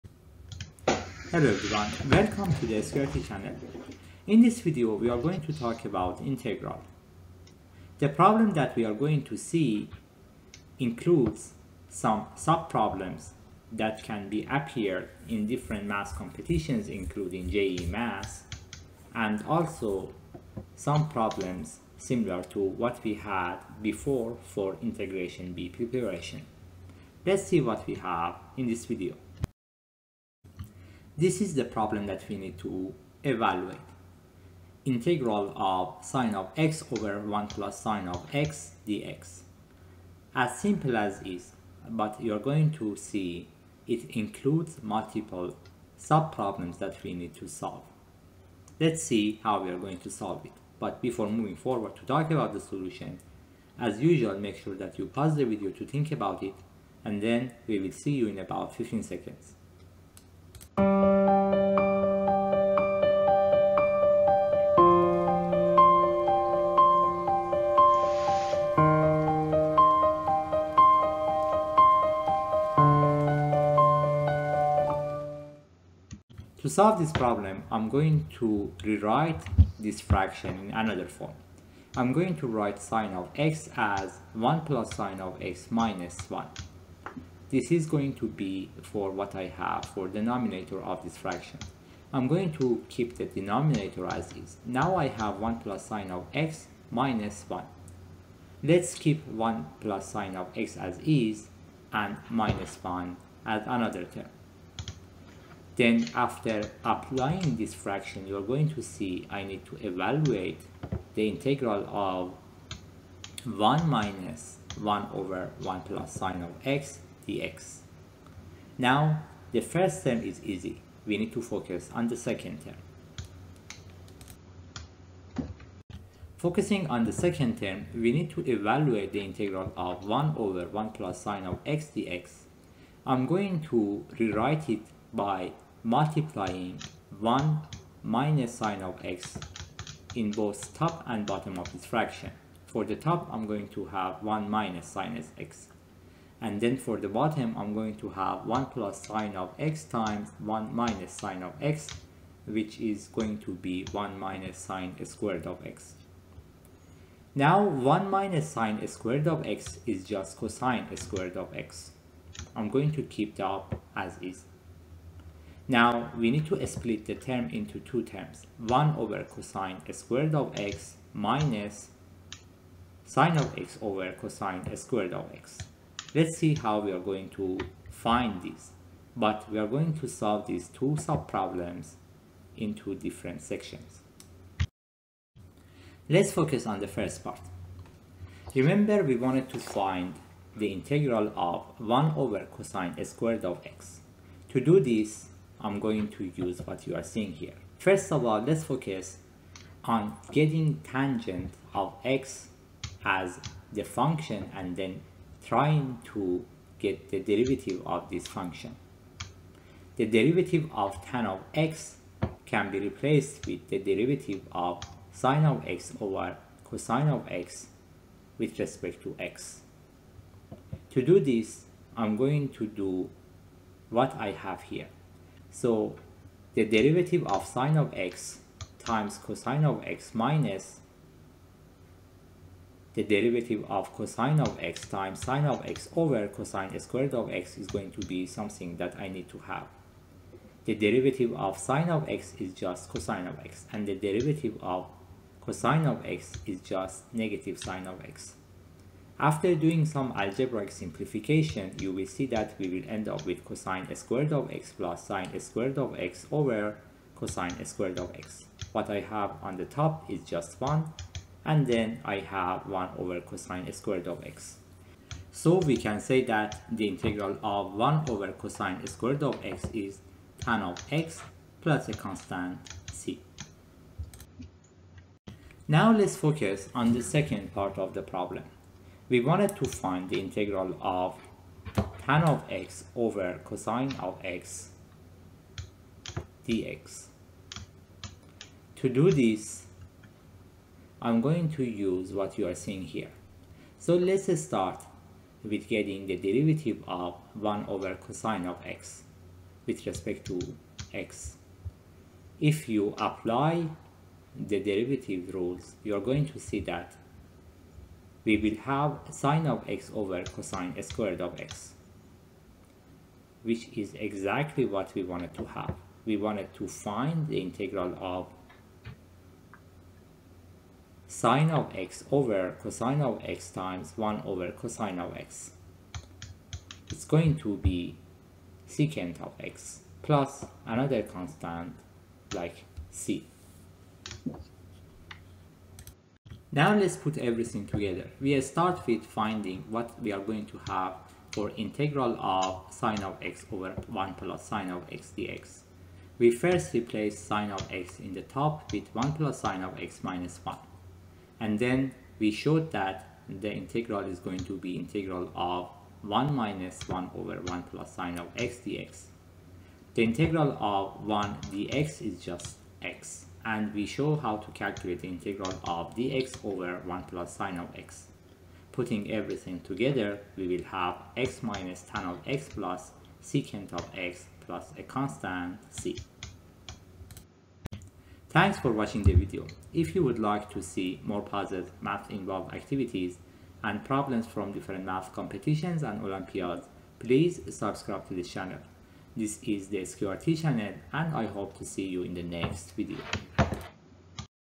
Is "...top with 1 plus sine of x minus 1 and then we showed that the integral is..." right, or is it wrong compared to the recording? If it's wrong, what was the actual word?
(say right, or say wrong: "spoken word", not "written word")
right.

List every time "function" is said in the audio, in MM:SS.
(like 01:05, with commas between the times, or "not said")
03:23, 03:28.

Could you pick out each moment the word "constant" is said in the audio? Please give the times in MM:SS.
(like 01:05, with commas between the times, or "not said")
04:31, 05:31, 06:14.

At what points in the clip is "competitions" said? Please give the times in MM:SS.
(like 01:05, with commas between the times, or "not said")
00:16, 06:25.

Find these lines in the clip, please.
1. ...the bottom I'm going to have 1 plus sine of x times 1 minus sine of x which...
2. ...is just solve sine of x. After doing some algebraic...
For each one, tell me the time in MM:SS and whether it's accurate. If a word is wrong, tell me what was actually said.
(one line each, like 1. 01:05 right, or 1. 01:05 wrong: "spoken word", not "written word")
1. 02:26 right
2. 04:06 wrong: "negative", not "solve".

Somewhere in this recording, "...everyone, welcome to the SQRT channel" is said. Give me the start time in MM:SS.
00:01.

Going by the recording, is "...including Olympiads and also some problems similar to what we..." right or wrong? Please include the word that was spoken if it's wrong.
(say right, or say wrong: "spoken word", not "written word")
wrong: "JEE", not "Olympiads".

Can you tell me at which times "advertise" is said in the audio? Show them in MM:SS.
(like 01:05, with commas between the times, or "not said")
not said.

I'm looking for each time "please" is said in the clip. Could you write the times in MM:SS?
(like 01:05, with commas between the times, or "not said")
06:26.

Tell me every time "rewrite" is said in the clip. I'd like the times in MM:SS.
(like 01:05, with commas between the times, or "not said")
01:18, 02:14.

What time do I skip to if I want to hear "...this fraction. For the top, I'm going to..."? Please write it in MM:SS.
02:21.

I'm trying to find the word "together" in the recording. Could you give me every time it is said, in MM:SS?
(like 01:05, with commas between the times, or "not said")
05:37, 06:09.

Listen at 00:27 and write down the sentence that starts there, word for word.
Let's see what we have in this video.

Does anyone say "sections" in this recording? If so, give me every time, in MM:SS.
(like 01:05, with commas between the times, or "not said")
03:03.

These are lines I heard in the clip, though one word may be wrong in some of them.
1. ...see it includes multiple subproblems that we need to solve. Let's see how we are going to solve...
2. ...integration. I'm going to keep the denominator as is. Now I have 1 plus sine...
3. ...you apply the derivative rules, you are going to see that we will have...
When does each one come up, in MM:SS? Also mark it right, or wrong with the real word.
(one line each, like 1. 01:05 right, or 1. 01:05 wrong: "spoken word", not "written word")
1. 00:42 right
2. 01:31 wrong: "fraction", not "integration"
3. 05:02 right.